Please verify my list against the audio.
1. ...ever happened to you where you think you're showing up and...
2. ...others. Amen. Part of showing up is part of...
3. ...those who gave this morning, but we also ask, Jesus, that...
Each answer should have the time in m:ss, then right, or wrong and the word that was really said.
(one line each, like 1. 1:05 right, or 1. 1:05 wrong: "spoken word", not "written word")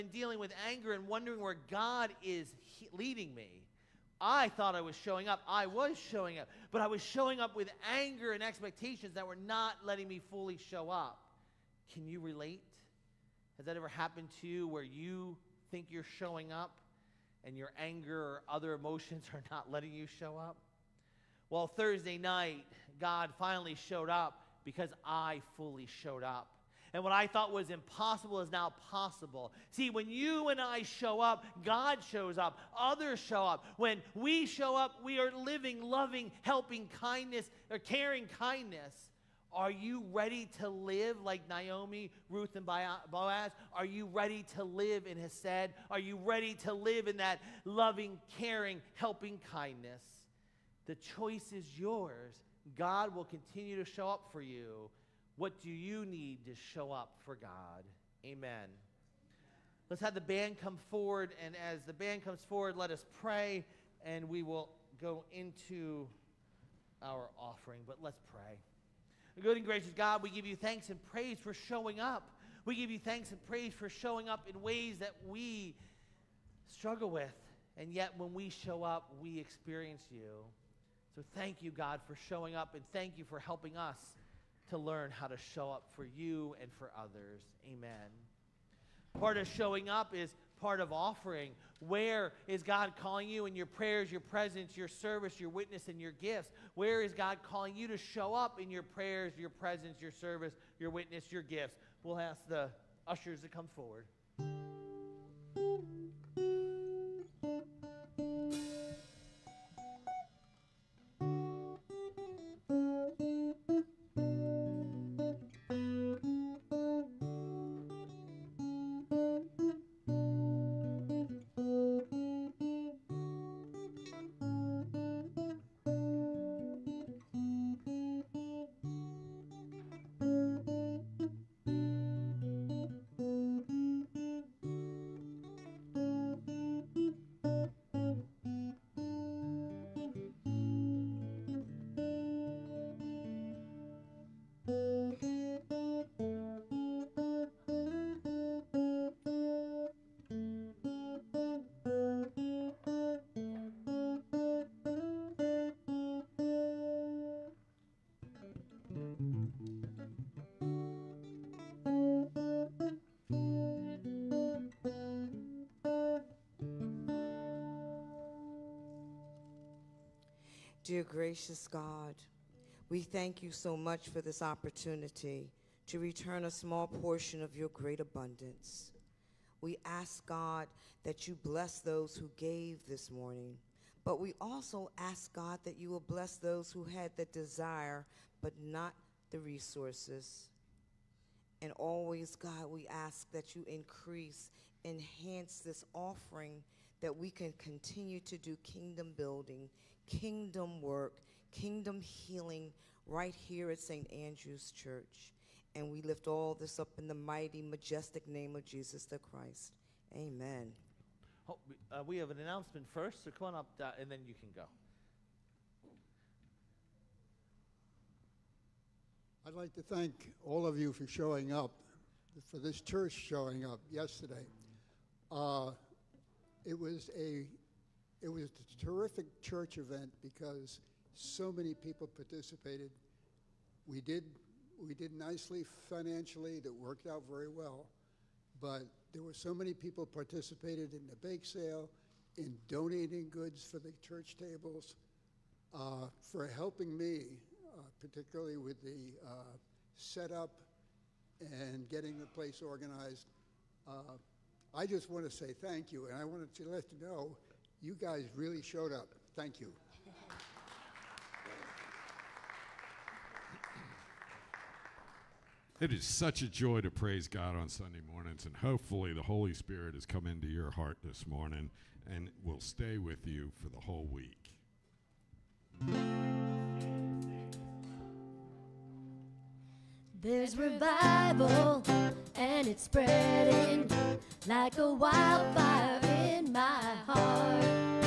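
1. 0:13 right
2. 1:26 right
3. 3:01 wrong: "God", not "Jesus".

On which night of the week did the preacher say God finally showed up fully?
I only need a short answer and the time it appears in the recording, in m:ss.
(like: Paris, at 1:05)
Thursday, at 0:21.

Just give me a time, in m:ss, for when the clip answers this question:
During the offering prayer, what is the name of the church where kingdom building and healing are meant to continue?
3:23.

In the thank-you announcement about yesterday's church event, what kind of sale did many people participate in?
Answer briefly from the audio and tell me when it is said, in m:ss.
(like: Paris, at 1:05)
Bake sale, at 4:01.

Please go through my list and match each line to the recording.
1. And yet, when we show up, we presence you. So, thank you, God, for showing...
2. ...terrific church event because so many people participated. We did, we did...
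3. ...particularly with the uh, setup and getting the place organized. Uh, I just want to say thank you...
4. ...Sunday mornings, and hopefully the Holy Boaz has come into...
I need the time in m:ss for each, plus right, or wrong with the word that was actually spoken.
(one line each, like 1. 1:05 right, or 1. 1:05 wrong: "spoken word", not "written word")
1. 1:17 wrong: "experience", not "presence"
2. 3:48 right
3. 4:08 right
4. 4:27 wrong: "Spirit", not "Boaz".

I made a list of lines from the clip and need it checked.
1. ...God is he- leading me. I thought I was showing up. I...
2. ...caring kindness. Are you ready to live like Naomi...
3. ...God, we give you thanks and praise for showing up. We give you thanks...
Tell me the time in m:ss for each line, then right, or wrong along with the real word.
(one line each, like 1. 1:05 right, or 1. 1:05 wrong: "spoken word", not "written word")
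1. 0:01 right
2. 0:37 right
3. 1:09 right.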